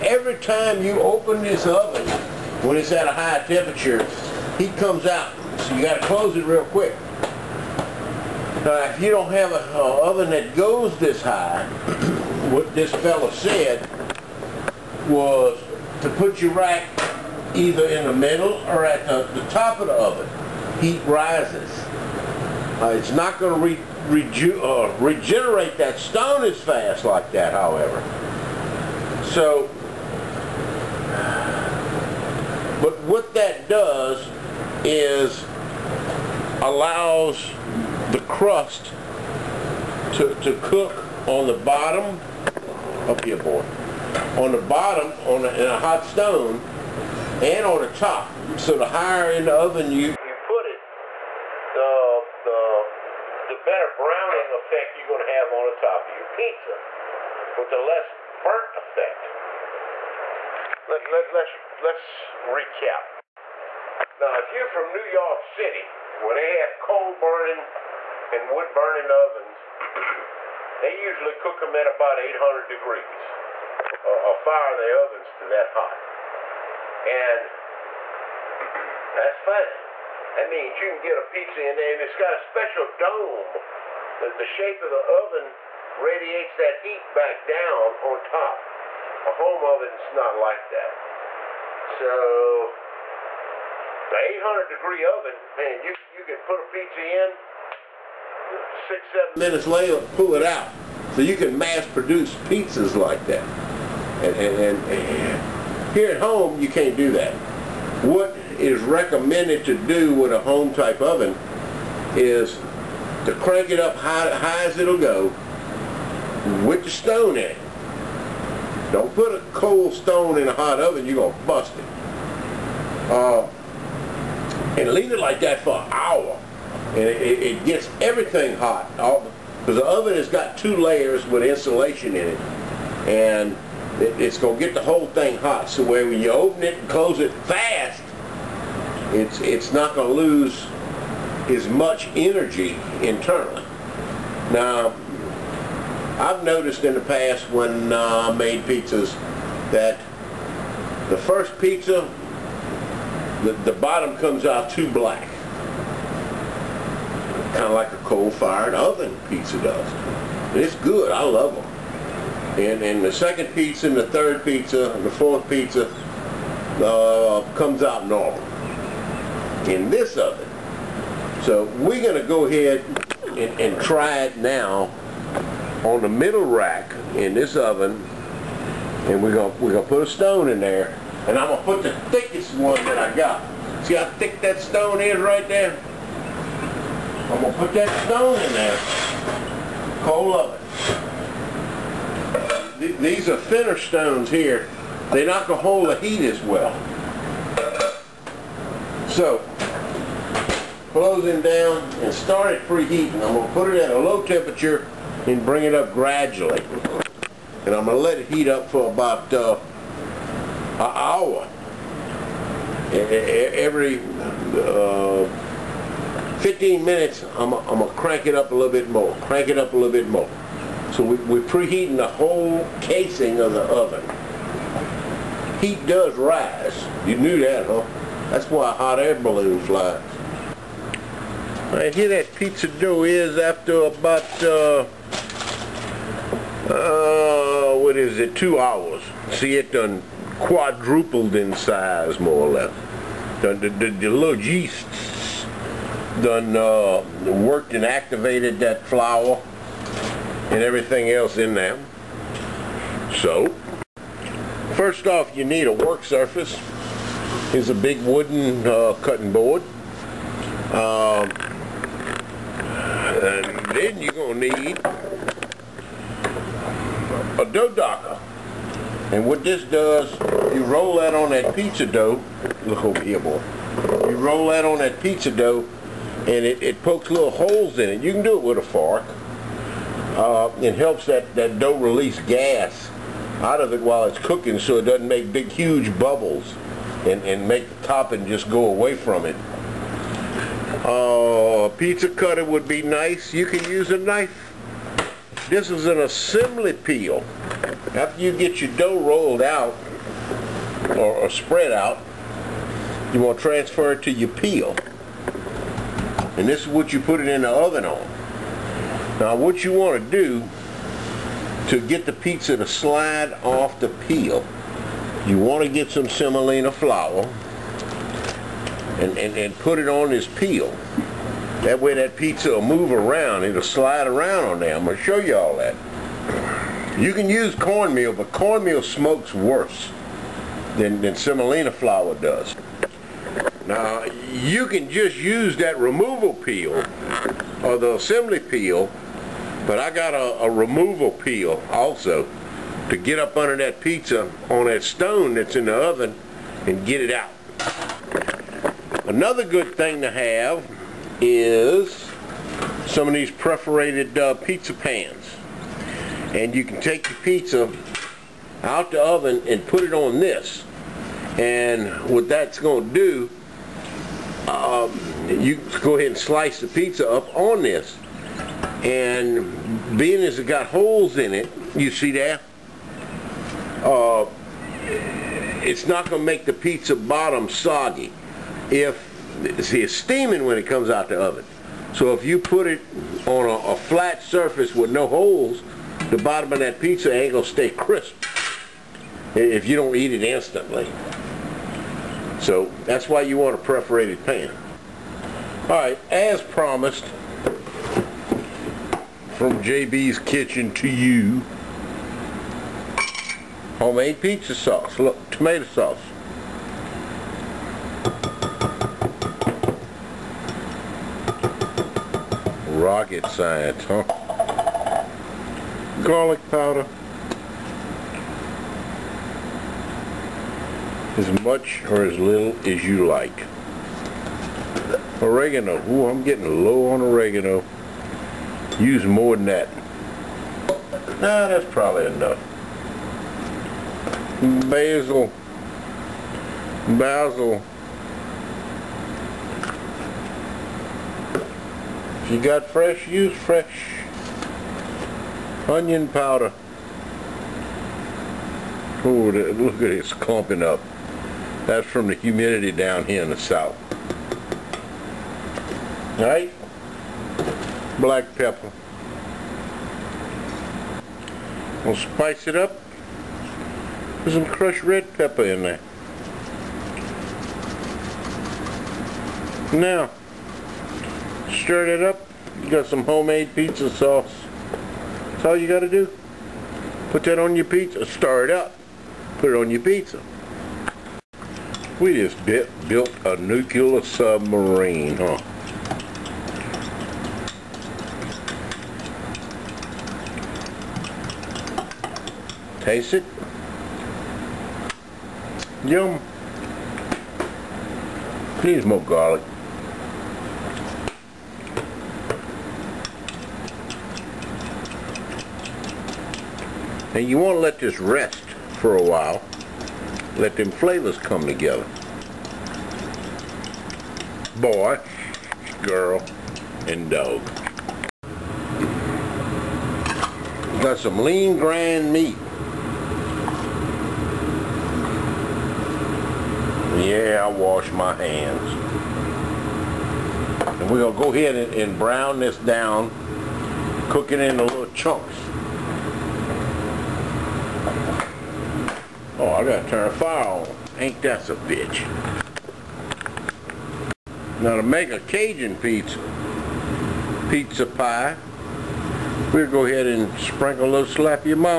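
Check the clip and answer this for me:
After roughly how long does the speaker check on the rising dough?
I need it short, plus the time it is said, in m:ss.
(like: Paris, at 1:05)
two hours, at 3:58.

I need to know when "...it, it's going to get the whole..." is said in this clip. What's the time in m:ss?
2:14.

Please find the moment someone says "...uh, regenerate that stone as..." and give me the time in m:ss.
0:24.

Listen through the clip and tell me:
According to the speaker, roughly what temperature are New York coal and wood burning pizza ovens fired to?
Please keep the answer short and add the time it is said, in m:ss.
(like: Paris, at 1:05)
800 degrees, at 1:12.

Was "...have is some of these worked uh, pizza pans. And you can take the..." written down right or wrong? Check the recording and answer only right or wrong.
wrong.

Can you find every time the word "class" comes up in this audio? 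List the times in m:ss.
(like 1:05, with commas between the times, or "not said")
not said.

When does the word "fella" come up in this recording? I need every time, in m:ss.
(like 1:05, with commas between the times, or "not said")
0:12.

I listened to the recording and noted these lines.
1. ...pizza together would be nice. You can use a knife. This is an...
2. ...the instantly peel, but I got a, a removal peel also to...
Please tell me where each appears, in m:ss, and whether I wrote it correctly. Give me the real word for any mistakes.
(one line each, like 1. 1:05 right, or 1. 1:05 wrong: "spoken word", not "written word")
1. 4:51 wrong: "cutter", not "together"
2. 5:37 wrong: "assembly", not "instantly".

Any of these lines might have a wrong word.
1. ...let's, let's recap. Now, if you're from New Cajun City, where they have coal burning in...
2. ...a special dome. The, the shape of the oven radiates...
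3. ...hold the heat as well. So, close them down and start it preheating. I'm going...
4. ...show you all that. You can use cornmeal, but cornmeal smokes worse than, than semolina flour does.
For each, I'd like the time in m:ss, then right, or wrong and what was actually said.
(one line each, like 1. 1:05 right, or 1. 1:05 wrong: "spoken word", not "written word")
1. 1:01 wrong: "York", not "Cajun"
2. 1:22 right
3. 3:15 right
4. 5:25 right.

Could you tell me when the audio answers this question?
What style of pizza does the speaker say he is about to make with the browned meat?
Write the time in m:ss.
9:05.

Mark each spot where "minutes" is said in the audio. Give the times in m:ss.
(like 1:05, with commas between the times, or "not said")
1:39, 3:36.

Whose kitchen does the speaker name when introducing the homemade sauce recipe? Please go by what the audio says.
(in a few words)
JB's Kitchen.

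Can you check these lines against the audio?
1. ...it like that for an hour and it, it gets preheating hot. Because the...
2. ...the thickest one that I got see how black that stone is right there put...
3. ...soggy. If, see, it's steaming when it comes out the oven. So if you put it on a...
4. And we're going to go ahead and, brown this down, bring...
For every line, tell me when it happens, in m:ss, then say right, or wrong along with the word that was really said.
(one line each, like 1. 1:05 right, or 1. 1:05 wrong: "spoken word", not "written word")
1. 2:05 wrong: "everything", not "preheating"
2. 3:01 wrong: "thick", not "black"
3. 6:17 right
4. 8:50 wrong: "cooking", not "bring".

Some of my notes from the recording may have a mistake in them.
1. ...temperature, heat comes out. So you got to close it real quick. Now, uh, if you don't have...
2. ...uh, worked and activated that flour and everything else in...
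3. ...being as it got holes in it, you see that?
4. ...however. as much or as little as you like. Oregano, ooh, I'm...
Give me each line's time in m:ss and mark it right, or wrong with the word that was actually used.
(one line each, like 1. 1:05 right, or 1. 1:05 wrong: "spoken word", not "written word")
1. 0:03 right
2. 4:06 right
3. 6:09 right
4. 6:56 wrong: "powder", not "however".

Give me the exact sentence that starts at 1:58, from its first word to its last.
Don't put a cold stone in a hot oven, you're going to bust it.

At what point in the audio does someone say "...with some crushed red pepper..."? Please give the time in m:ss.
7:44.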